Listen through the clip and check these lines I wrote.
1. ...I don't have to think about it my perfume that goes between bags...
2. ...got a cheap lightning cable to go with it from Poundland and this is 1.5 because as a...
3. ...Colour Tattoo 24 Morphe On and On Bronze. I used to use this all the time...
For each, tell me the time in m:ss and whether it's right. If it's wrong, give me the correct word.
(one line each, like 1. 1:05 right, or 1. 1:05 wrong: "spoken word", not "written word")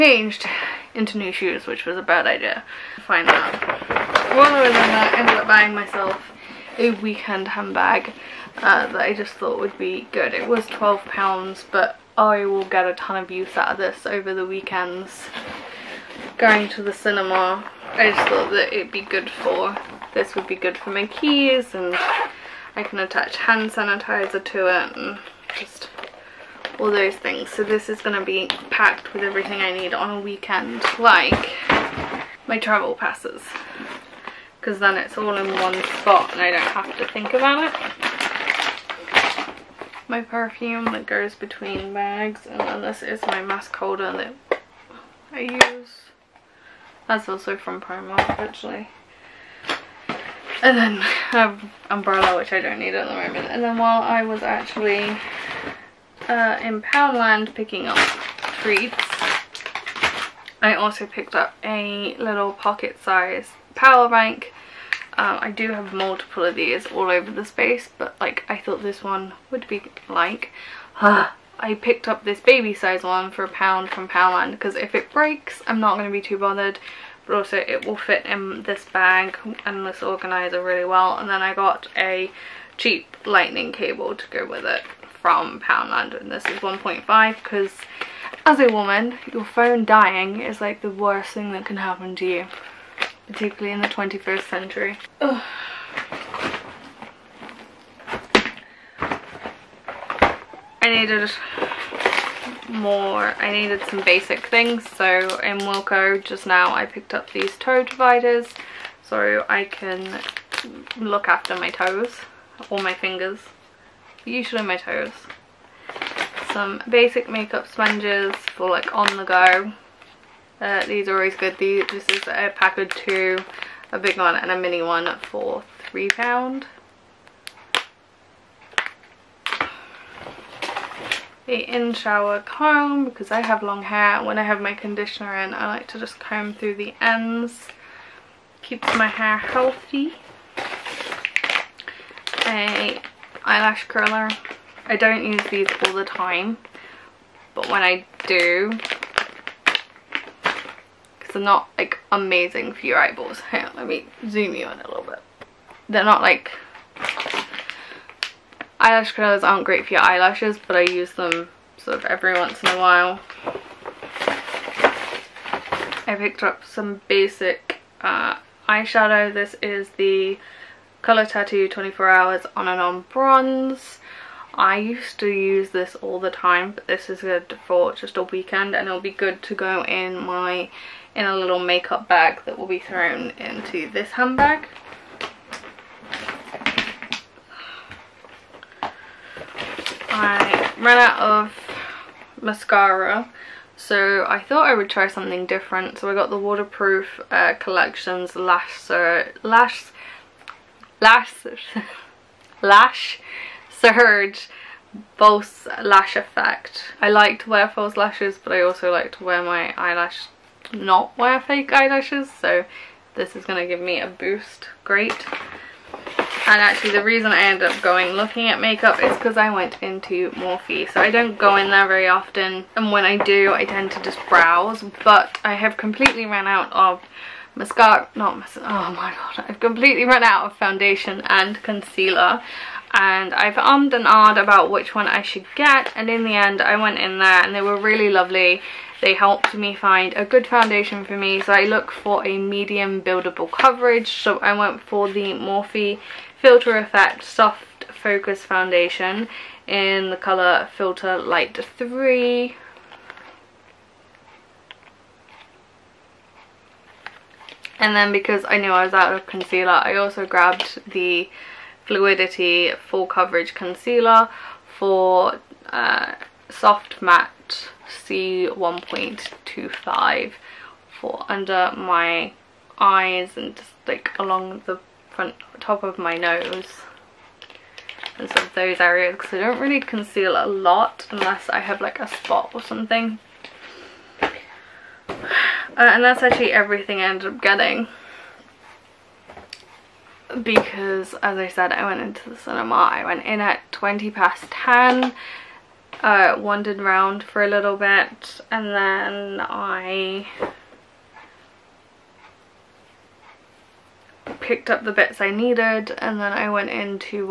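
1. 0:36 right
2. 1:21 right
3. 2:51 wrong: "Hours", not "Morphe".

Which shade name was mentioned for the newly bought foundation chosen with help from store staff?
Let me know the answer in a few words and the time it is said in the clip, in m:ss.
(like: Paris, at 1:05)
Filter Light 3, at 4:10.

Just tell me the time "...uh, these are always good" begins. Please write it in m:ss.
2:00.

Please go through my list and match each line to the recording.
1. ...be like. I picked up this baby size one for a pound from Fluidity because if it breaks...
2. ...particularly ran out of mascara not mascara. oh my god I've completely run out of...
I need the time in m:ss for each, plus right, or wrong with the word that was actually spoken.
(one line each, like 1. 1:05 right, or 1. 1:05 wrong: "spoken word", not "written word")
1. 1:09 wrong: "Poundland", not "Fluidity"
2. 3:45 wrong: "completely", not "particularly".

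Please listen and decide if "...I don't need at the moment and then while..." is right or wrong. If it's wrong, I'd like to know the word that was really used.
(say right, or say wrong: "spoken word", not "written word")
right.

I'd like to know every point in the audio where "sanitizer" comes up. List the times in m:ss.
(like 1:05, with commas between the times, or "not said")
0:23.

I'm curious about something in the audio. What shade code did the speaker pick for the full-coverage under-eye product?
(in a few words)
C1.25.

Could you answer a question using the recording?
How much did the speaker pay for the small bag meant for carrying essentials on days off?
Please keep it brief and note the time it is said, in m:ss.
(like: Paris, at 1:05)
£12, at 0:10.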